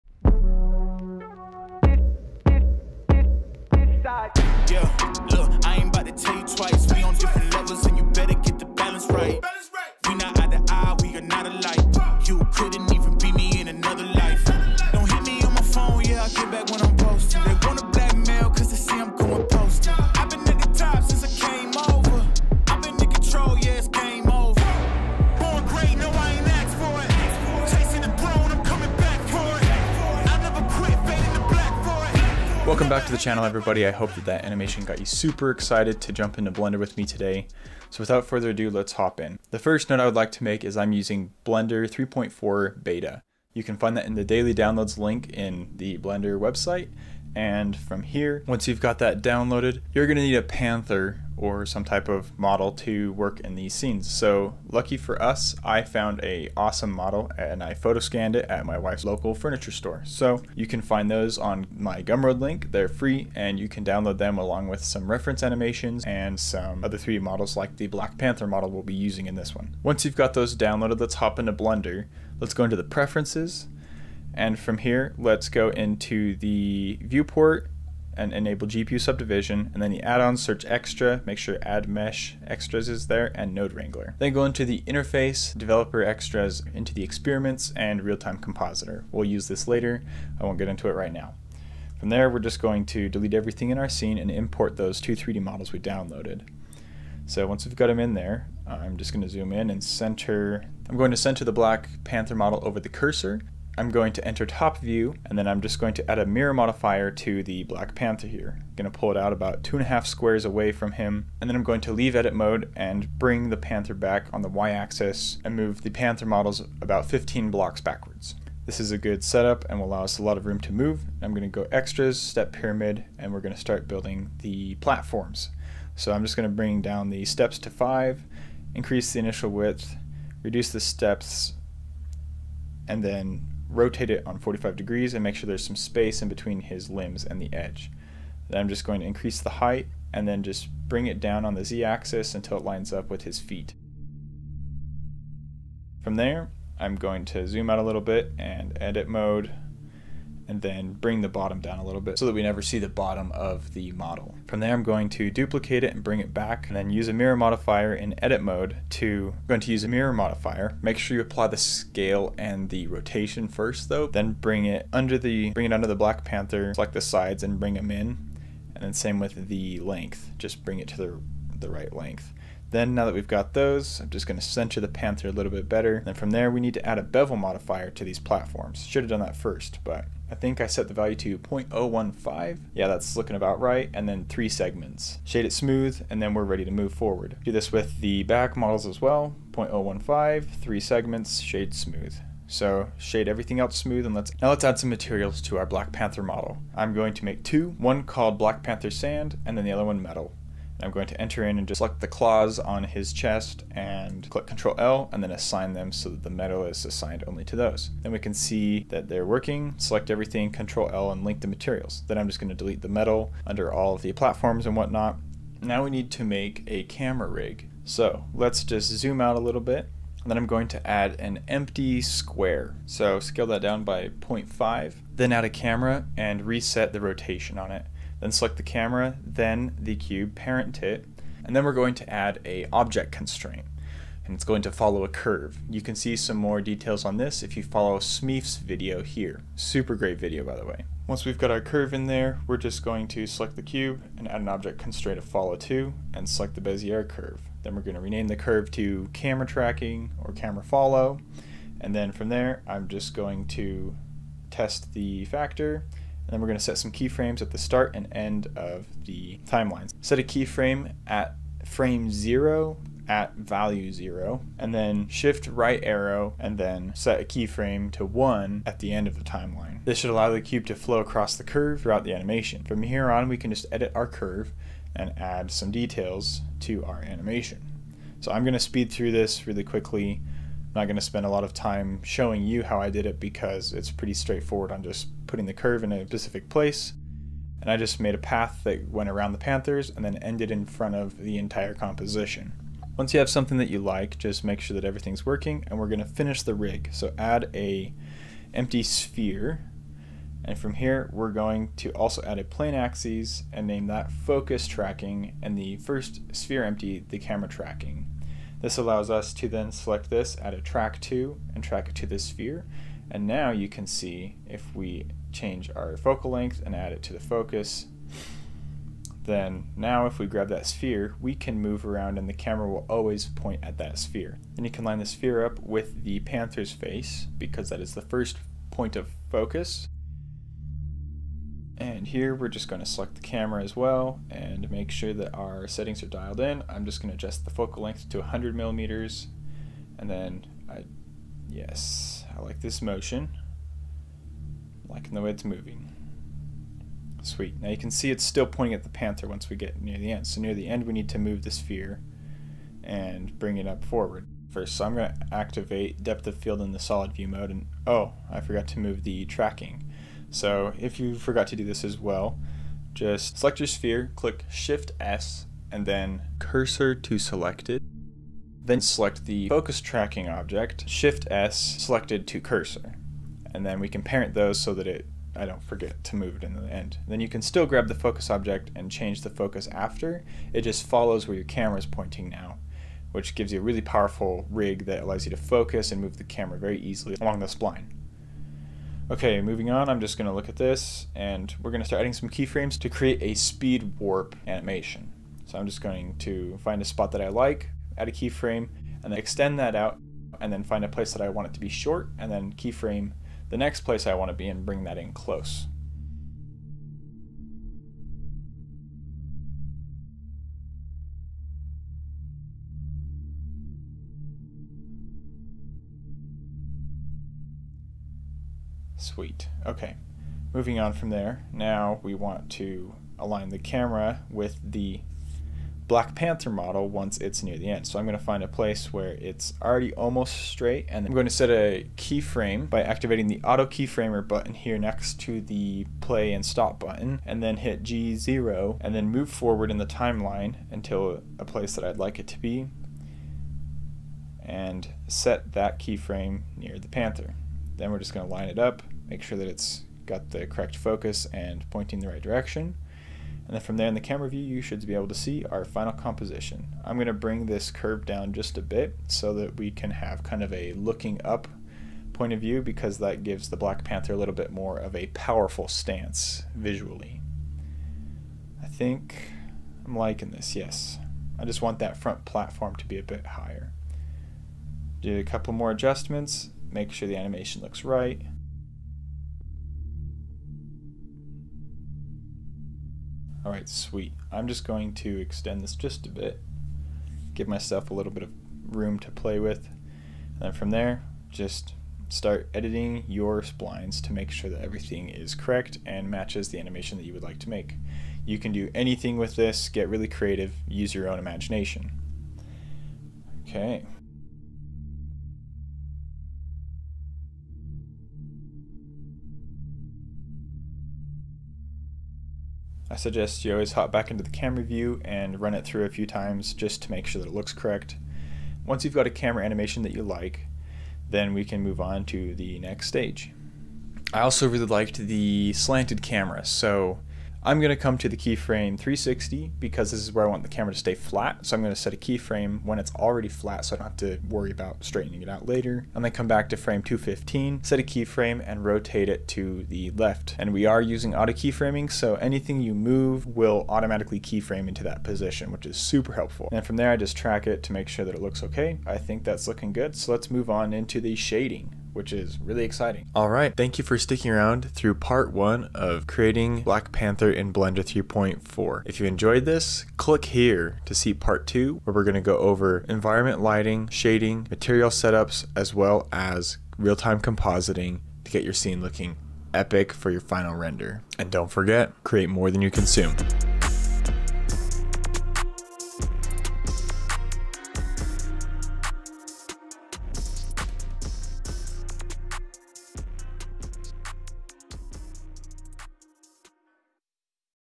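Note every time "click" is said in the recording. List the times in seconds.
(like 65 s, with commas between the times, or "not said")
204 s, 364 s, 559 s.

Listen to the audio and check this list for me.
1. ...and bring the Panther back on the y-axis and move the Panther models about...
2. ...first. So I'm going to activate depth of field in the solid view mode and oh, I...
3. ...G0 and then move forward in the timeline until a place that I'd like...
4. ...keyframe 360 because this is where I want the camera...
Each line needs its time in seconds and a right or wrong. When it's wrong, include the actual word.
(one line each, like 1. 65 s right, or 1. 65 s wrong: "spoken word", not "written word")
1. 112 s right
2. 354 s right
3. 437 s right
4. 528 s right.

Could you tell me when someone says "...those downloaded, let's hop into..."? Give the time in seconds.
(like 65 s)
70 s.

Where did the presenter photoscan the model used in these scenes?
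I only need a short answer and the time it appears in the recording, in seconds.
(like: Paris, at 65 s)
wife's local furniture store, at 58 s.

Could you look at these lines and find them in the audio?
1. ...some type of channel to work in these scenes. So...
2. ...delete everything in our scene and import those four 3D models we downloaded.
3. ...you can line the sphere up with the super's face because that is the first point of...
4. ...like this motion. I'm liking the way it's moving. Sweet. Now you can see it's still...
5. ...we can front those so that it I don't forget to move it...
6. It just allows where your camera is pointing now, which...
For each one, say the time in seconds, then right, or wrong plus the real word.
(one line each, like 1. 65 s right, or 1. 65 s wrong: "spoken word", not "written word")
1. 51 s wrong: "model", not "channel"
2. 93 s wrong: "two", not "four"
3. 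324 s wrong: "panther", not "super"
4. 342 s right
5. 373 s wrong: "parent", not "front"
6. 380 s wrong: "follows", not "allows".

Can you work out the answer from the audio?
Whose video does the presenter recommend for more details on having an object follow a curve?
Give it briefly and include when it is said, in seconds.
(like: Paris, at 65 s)
Smeef, at 237 s.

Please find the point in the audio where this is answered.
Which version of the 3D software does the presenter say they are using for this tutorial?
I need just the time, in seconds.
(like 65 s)
41 s.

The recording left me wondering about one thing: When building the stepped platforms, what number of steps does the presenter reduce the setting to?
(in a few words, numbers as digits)
5.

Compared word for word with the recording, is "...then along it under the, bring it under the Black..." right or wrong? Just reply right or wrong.
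wrong.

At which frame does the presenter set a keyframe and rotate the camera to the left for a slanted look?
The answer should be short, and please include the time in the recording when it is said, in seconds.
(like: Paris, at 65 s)
215, at 536 s.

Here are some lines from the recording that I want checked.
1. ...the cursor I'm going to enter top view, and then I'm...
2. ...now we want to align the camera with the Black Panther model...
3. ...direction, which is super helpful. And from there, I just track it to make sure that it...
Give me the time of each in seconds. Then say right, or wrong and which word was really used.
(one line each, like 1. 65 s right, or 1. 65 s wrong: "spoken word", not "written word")
1. 102 s right
2. 421 s right
3. 545 s wrong: "position", not "direction".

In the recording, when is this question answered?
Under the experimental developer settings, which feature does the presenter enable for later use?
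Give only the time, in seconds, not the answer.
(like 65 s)
88 s.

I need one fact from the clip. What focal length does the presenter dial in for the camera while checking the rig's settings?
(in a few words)
100 millimeters.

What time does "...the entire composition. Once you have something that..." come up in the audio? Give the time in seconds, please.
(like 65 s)
291 s.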